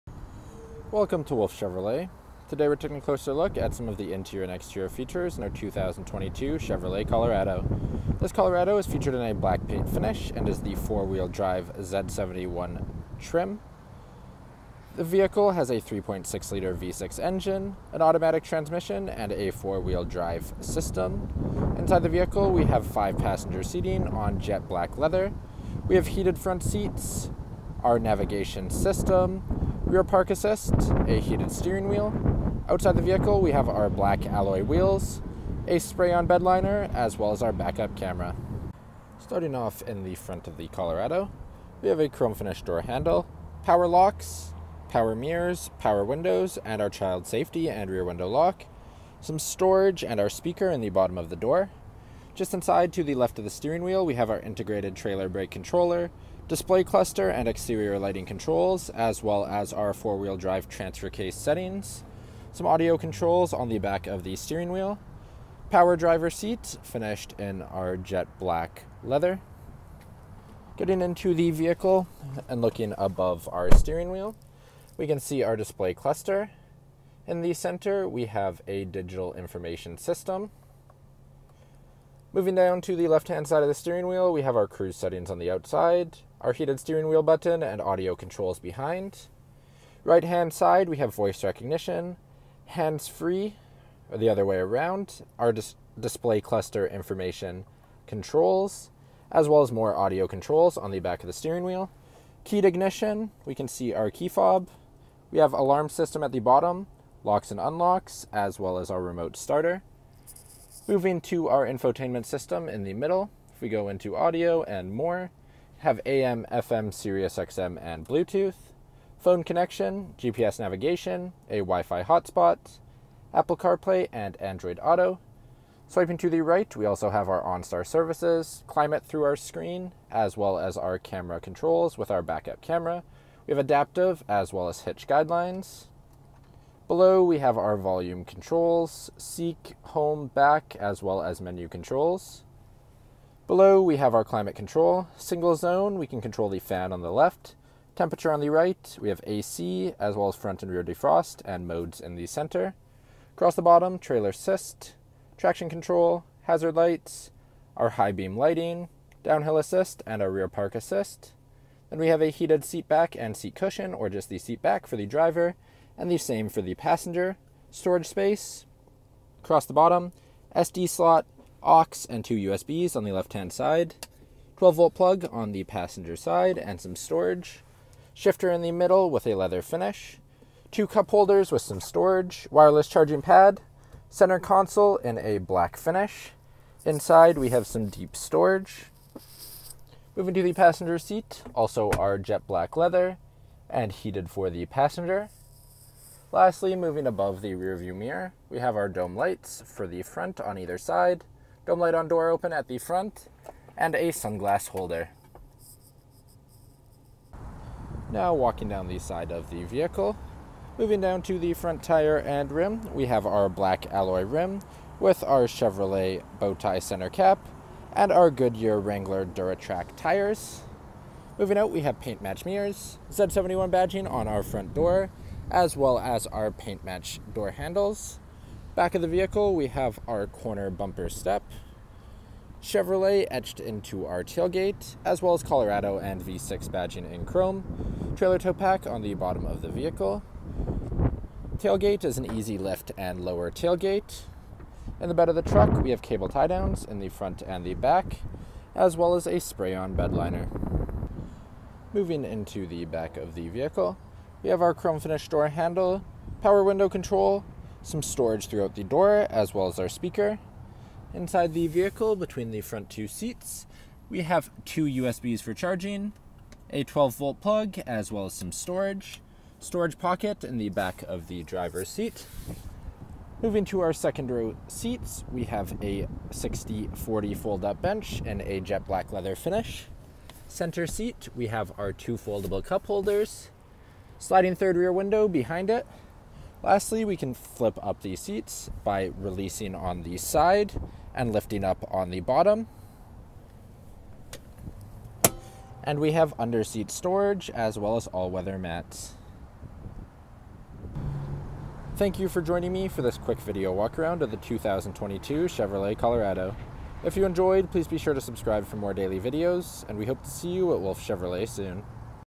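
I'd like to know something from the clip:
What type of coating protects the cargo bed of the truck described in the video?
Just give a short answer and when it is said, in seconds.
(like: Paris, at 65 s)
Spray-on bed liner, at 35 s.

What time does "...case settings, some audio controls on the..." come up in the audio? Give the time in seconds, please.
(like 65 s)
61 s.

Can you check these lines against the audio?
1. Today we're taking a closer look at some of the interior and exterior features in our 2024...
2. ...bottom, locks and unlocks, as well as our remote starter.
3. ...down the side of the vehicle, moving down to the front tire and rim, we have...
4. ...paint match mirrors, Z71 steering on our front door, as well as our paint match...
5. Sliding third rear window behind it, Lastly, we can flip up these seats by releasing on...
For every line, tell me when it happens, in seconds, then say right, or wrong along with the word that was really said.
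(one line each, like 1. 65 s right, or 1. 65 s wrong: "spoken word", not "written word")
1. 2 s wrong: "2022", not "2024"
2. 106 s right
3. 208 s right
4. 222 s wrong: "badging", not "steering"
5. 284 s right.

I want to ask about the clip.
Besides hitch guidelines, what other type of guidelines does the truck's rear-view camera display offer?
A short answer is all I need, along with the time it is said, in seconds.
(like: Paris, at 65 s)
Adaptive, at 133 s.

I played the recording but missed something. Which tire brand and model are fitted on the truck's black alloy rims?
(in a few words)
Goodyear Wrangler DuraTrac.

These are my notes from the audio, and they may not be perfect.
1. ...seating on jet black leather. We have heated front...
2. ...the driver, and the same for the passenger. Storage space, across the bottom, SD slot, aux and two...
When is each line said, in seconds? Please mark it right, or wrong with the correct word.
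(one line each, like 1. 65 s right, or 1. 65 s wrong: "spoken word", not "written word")
1. 23 s right
2. 164 s right.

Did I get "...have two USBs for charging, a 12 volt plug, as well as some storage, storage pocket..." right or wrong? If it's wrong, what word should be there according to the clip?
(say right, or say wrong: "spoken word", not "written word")
right.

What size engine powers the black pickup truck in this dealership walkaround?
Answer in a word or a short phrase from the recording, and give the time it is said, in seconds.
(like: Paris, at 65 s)
3.6-liter V6, at 15 s.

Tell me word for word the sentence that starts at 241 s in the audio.
Tailgate is an easy lift and lower tailgate.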